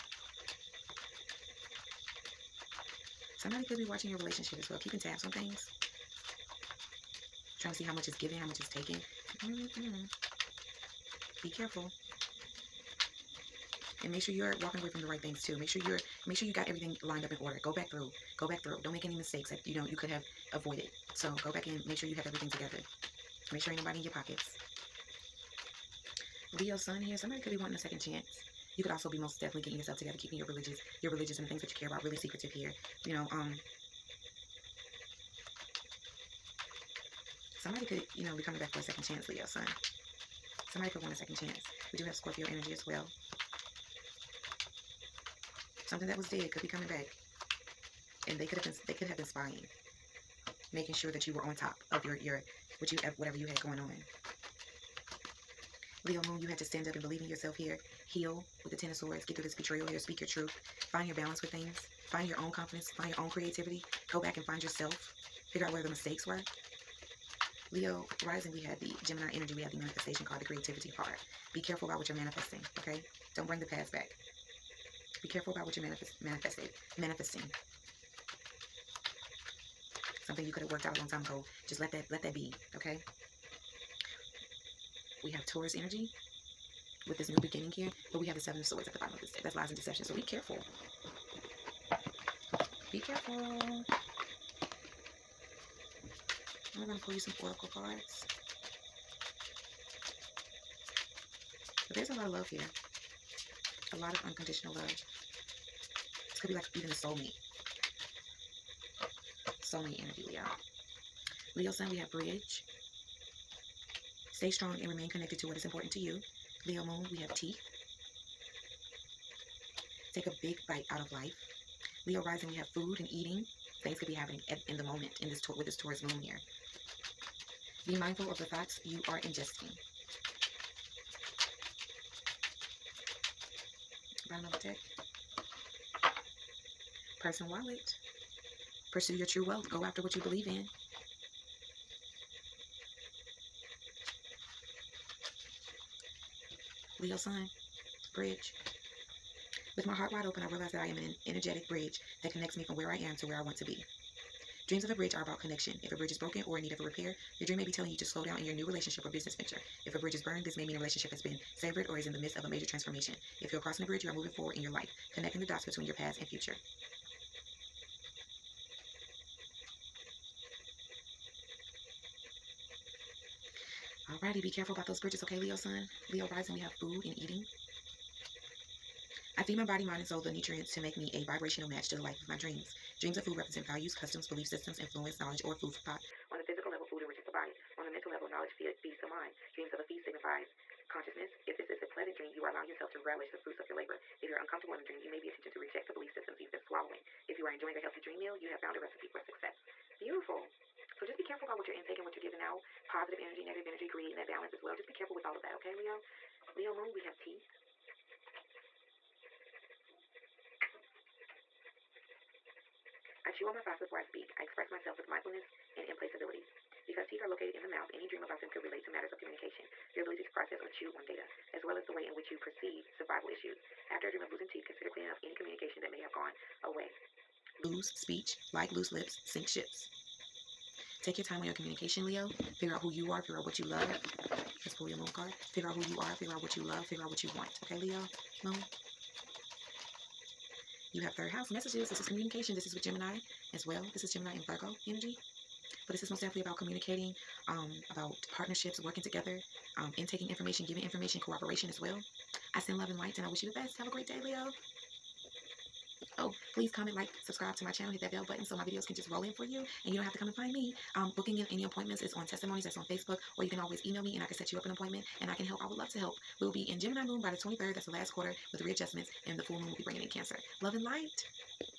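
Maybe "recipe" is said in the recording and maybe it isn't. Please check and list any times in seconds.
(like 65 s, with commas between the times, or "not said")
198 s.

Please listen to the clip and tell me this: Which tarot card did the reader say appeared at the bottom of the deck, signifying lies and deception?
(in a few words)
Seven of Swords.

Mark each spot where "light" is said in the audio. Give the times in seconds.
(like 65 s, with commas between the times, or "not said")
252 s, 270 s.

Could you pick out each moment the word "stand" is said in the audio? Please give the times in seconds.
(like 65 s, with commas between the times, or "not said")
56 s.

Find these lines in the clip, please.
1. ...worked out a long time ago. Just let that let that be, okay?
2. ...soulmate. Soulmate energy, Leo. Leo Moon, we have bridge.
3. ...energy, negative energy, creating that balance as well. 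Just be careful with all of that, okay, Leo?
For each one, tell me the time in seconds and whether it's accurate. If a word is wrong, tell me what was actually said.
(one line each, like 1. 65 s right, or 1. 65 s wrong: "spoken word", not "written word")
1. 80 s right
2. 106 s wrong: "Sun", not "Moon"
3. 203 s right.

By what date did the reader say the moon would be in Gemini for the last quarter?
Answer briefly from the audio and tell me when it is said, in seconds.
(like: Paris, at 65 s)
23rd, at 267 s.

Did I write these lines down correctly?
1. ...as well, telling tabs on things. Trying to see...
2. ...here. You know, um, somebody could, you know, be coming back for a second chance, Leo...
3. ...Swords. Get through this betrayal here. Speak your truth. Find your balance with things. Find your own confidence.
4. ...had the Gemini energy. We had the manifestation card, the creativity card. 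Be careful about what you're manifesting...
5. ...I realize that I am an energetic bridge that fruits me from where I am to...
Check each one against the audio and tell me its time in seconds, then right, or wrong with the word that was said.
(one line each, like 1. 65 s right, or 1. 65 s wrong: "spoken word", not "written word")
1. 4 s wrong: "keeping", not "telling"
2. 32 s right
3. 58 s right
4. 68 s right
5. 150 s wrong: "connects", not "fruits".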